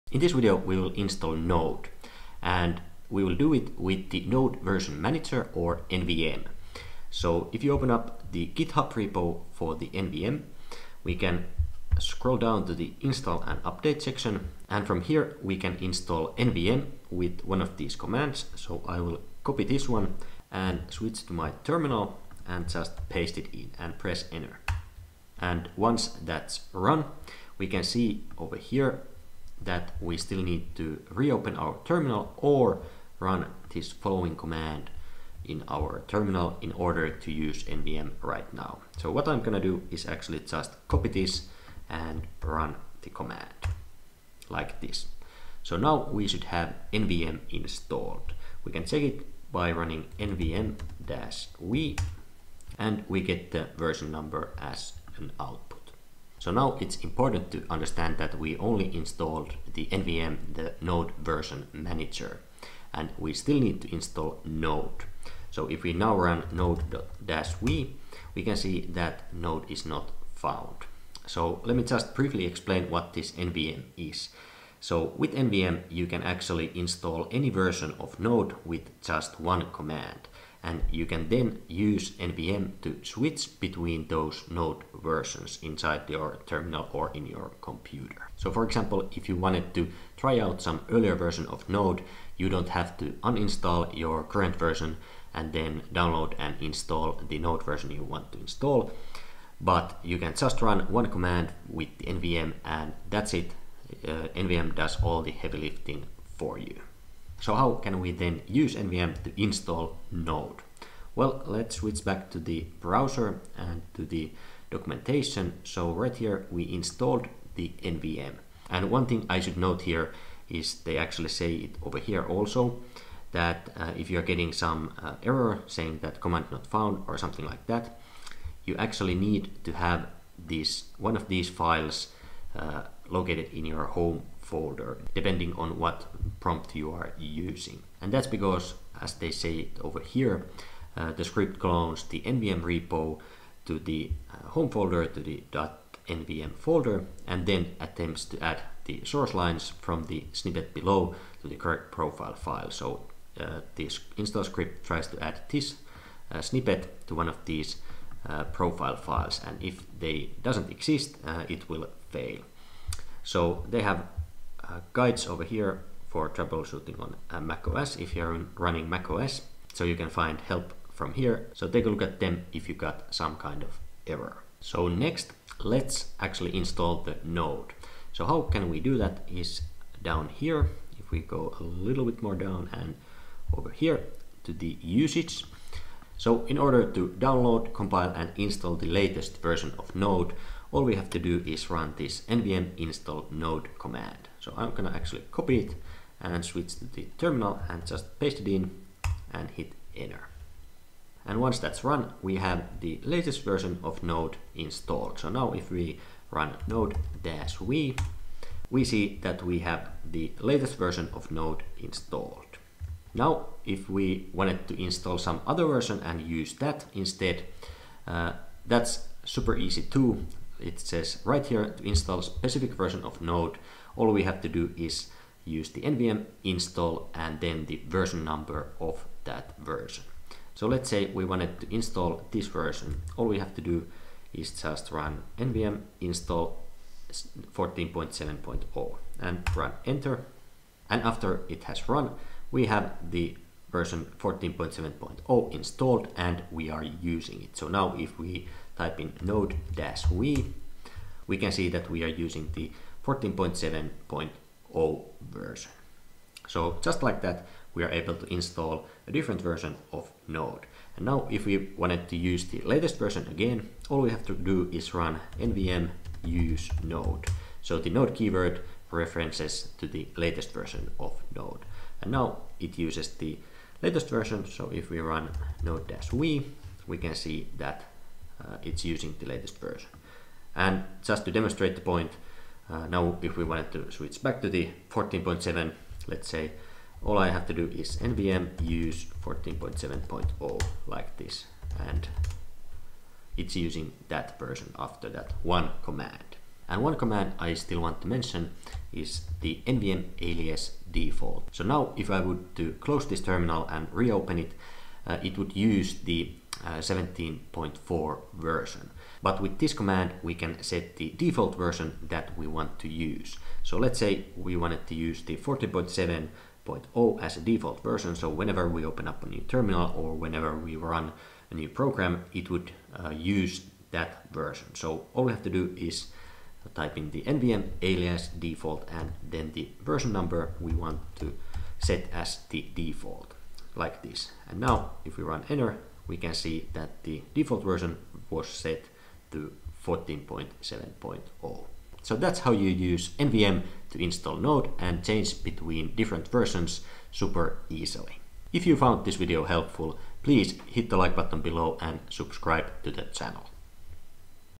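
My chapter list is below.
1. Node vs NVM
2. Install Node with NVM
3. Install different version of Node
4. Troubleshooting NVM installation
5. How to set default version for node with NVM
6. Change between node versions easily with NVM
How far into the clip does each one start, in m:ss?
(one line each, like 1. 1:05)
1. 0:56
2. 2:54
3. 3:33
4. 1:47
5. 4:56
6. 4:20.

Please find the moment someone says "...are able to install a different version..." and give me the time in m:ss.
4:17.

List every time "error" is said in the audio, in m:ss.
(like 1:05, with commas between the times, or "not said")
2:05, 2:54.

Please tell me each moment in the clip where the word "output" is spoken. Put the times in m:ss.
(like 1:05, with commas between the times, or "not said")
0:55.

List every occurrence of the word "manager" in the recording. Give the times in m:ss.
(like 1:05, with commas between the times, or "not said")
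0:05, 1:01.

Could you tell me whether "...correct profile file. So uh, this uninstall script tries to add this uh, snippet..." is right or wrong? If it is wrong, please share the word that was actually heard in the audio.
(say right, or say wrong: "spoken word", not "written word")
wrong: "install", not "uninstall".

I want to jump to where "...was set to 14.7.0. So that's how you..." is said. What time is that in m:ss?
5:38.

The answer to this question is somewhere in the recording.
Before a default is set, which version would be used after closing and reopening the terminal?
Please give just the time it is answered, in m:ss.
5:06.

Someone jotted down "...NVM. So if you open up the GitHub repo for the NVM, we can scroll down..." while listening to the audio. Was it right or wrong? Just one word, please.
right.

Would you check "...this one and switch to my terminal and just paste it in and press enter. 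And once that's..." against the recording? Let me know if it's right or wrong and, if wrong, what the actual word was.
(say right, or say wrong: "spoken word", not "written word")
right.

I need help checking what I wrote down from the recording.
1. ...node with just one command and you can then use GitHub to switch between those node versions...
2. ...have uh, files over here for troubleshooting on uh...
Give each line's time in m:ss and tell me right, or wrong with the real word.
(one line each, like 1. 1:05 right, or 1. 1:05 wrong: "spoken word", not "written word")
1. 1:18 wrong: "NVM", not "GitHub"
2. 2:43 wrong: "guides", not "files".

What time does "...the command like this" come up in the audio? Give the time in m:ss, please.
0:43.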